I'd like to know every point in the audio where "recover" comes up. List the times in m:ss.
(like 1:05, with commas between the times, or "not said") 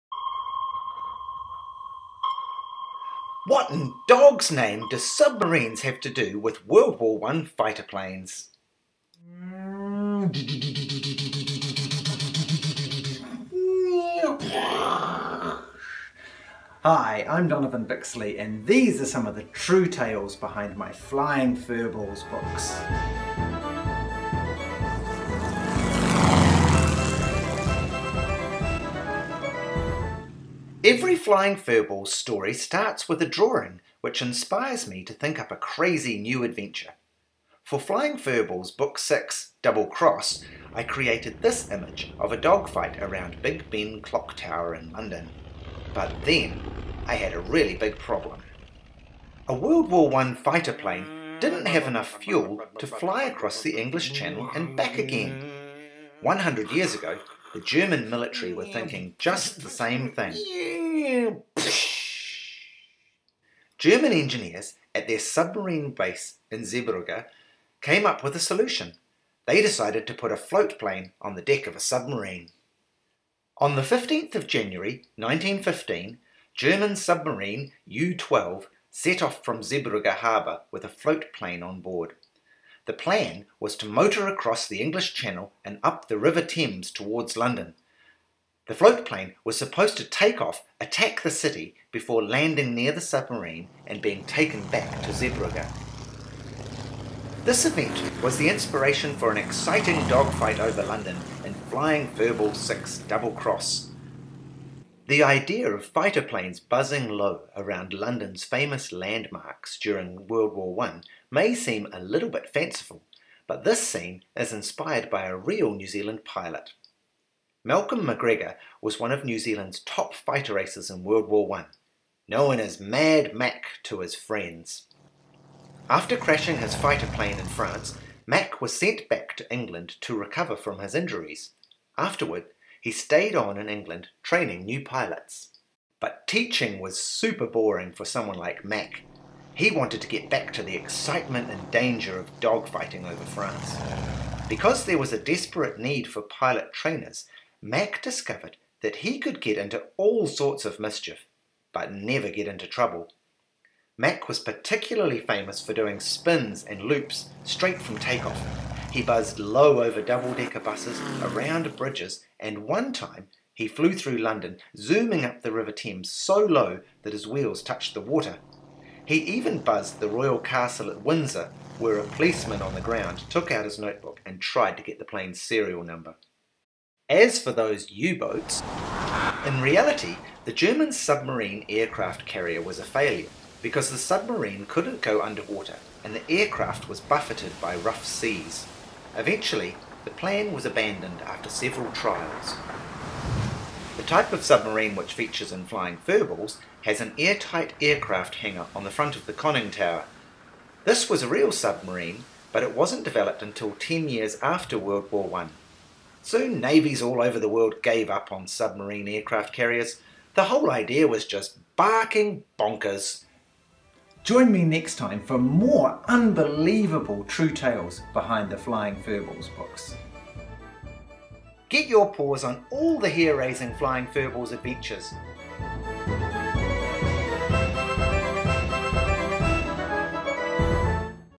2:10.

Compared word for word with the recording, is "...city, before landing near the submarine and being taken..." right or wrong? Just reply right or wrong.
right.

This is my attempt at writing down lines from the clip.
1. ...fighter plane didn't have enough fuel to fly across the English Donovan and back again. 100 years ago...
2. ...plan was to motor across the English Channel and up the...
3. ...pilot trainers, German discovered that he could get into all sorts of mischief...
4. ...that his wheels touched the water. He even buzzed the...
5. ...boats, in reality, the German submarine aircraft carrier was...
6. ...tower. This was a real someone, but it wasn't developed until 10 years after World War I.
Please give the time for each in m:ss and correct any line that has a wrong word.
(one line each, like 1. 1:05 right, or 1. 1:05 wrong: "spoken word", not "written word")
1. 0:50 wrong: "Channel", not "Donovan"
2. 1:22 right
3. 2:26 wrong: "Mac", not "German"
4. 2:47 right
5. 2:58 right
6. 3:19 wrong: "submarine", not "someone".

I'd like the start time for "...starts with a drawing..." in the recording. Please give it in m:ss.
0:32.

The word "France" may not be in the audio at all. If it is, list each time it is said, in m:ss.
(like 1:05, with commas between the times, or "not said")
2:07, 2:23.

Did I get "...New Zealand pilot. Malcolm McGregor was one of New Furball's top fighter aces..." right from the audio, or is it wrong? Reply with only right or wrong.
wrong.